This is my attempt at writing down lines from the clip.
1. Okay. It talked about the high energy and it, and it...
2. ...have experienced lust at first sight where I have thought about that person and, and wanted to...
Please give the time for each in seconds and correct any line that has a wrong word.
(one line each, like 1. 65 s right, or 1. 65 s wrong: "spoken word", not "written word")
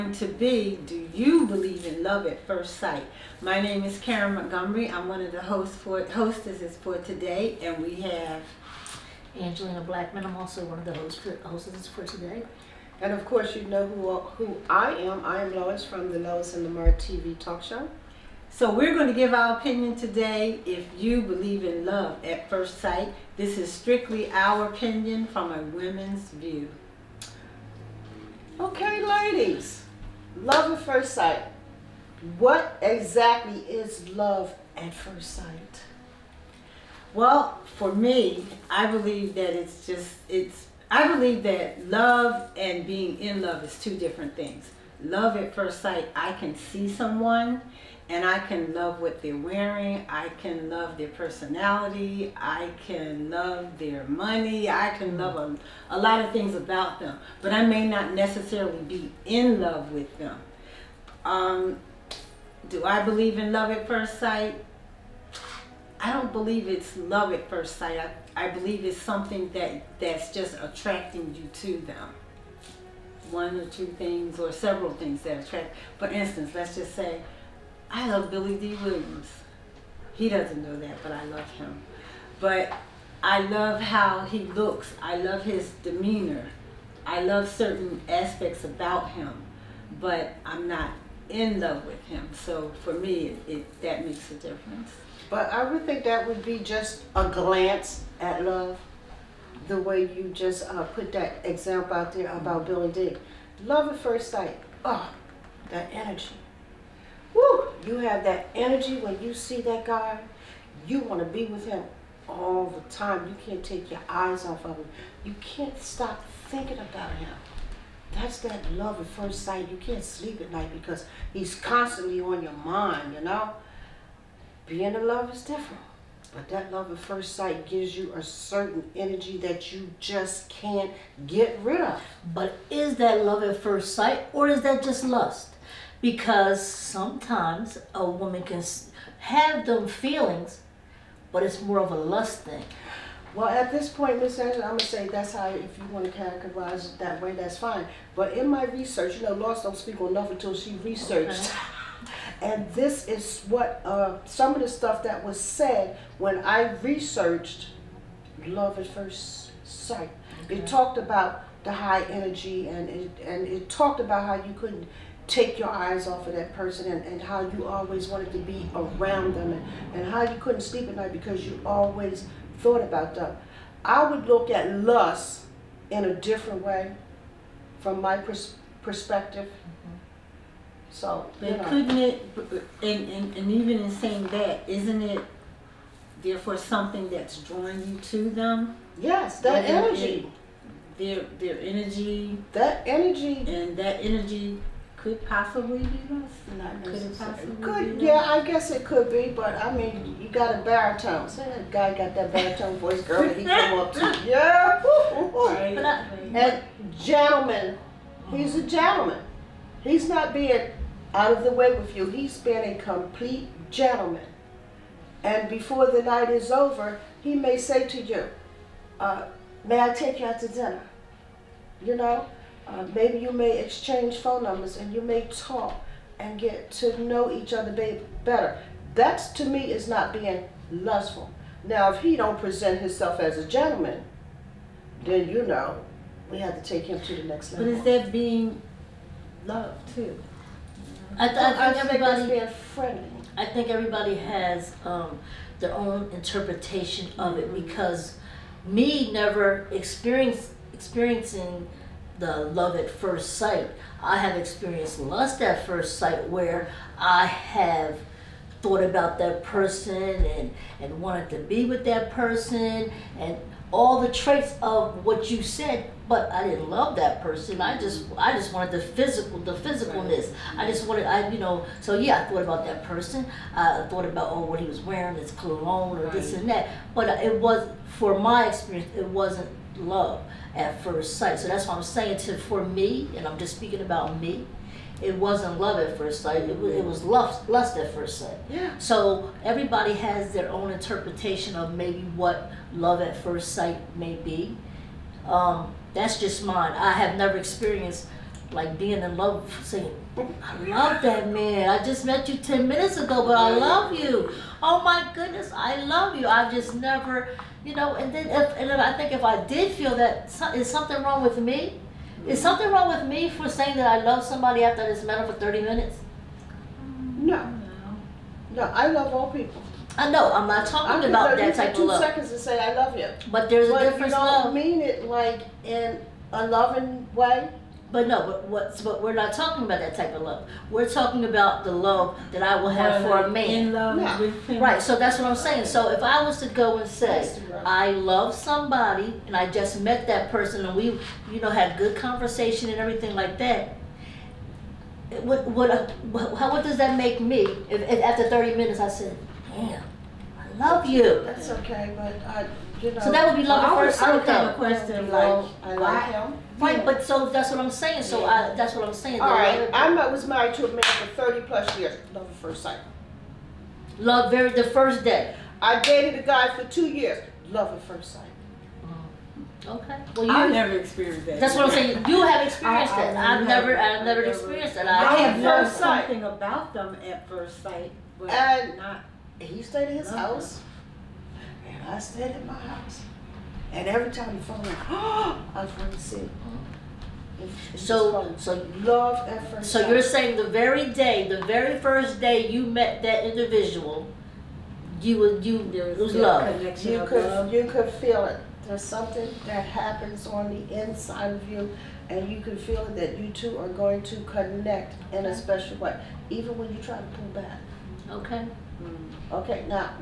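1. 160 s right
2. 254 s right.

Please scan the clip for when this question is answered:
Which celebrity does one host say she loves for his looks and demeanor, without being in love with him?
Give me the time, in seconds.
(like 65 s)
78 s.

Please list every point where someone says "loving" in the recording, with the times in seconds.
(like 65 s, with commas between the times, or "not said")
326 s.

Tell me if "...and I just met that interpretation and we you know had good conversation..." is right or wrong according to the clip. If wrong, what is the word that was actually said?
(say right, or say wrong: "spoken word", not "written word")
wrong: "person", not "interpretation".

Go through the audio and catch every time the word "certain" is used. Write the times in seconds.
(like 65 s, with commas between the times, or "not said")
87 s, 128 s.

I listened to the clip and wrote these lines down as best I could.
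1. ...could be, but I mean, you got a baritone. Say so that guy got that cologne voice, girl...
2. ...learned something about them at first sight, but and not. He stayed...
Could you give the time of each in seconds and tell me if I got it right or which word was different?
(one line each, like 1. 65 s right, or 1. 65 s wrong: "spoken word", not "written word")
1. 198 s wrong: "baritone", not "cologne"
2. 375 s right.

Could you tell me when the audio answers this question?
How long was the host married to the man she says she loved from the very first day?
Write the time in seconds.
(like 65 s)
361 s.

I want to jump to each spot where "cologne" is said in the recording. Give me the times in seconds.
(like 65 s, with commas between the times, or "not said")
275 s.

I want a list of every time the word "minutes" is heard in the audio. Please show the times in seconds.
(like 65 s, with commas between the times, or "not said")
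302 s, 315 s, 348 s.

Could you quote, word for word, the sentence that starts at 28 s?
Okay, ladies, love at first sight.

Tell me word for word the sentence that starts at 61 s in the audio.
Um, do I believe in love at first sight?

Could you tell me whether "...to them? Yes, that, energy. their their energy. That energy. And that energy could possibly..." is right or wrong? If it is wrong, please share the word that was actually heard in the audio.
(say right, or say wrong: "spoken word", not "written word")
right.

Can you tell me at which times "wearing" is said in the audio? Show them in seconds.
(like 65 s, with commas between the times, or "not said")
49 s, 274 s.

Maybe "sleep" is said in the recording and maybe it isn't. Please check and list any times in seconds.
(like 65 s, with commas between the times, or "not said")
120 s, 170 s.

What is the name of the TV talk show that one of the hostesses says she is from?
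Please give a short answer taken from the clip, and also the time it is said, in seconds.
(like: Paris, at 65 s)
Lois and Lamar, at 16 s.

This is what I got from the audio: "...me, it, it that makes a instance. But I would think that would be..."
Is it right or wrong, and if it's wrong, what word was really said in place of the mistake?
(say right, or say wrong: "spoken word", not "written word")
wrong: "difference", not "instance".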